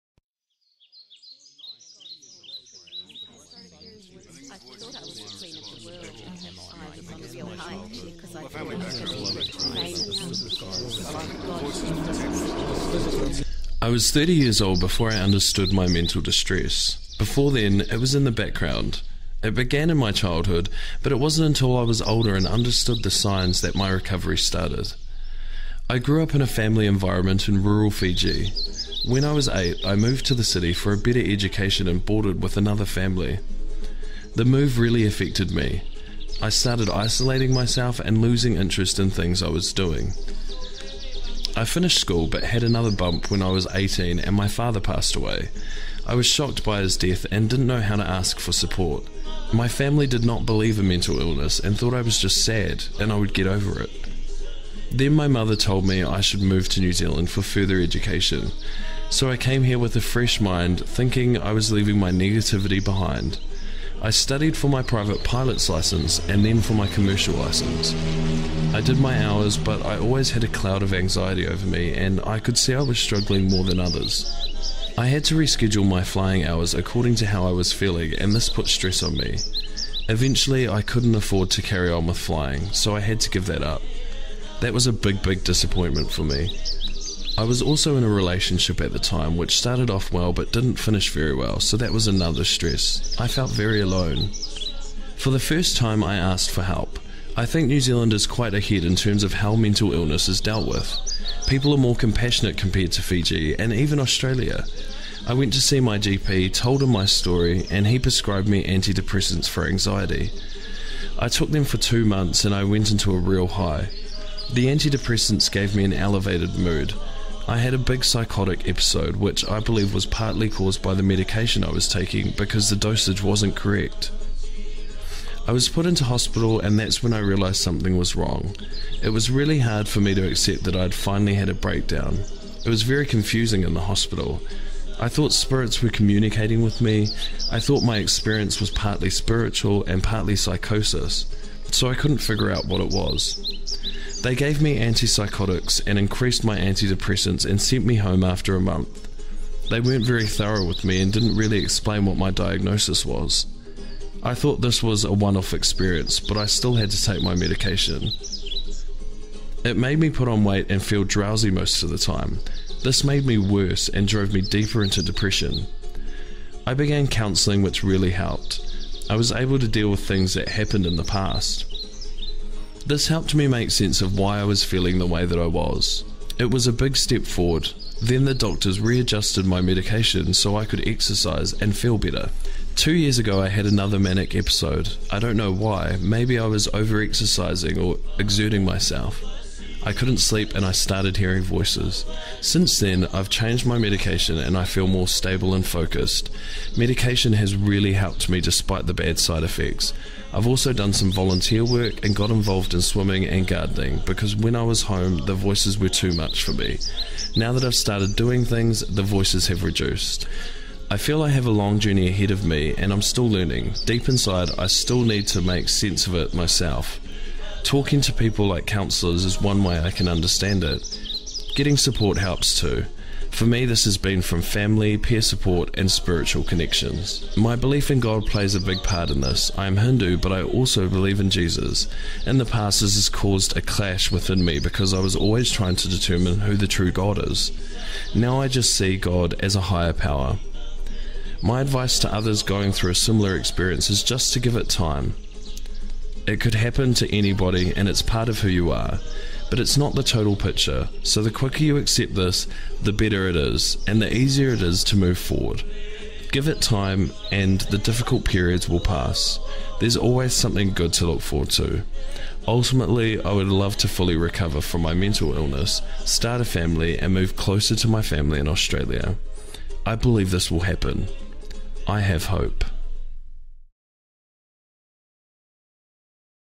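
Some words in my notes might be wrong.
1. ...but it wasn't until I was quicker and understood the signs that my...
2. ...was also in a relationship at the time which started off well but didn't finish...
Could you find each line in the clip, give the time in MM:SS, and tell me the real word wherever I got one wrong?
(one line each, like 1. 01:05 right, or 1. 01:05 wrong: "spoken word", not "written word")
1. 00:21 wrong: "older", not "quicker"
2. 01:27 right.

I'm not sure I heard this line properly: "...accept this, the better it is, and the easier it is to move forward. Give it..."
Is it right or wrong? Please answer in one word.
right.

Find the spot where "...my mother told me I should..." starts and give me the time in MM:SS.
00:55.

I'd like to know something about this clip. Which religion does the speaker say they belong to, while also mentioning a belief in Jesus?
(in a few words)
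Hindu.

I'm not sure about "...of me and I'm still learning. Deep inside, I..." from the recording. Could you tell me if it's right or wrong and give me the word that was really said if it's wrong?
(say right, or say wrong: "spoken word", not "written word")
right.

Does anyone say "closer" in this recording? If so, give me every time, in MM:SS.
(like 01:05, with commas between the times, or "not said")
04:27.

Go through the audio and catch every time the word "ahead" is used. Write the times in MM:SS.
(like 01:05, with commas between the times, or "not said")
01:38, 03:32.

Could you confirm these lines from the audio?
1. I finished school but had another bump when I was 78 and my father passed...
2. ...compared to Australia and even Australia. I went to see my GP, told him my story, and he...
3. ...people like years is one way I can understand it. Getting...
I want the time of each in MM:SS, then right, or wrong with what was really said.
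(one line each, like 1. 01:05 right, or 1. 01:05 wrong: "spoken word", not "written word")
1. 00:41 wrong: "18", not "78"
2. 01:42 wrong: "Fiji", not "Australia"
3. 03:38 wrong: "counsellors", not "years".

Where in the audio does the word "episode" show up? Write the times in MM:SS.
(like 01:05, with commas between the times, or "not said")
01:58, 03:04.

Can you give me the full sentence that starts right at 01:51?
I took them for two months and I went into a real high.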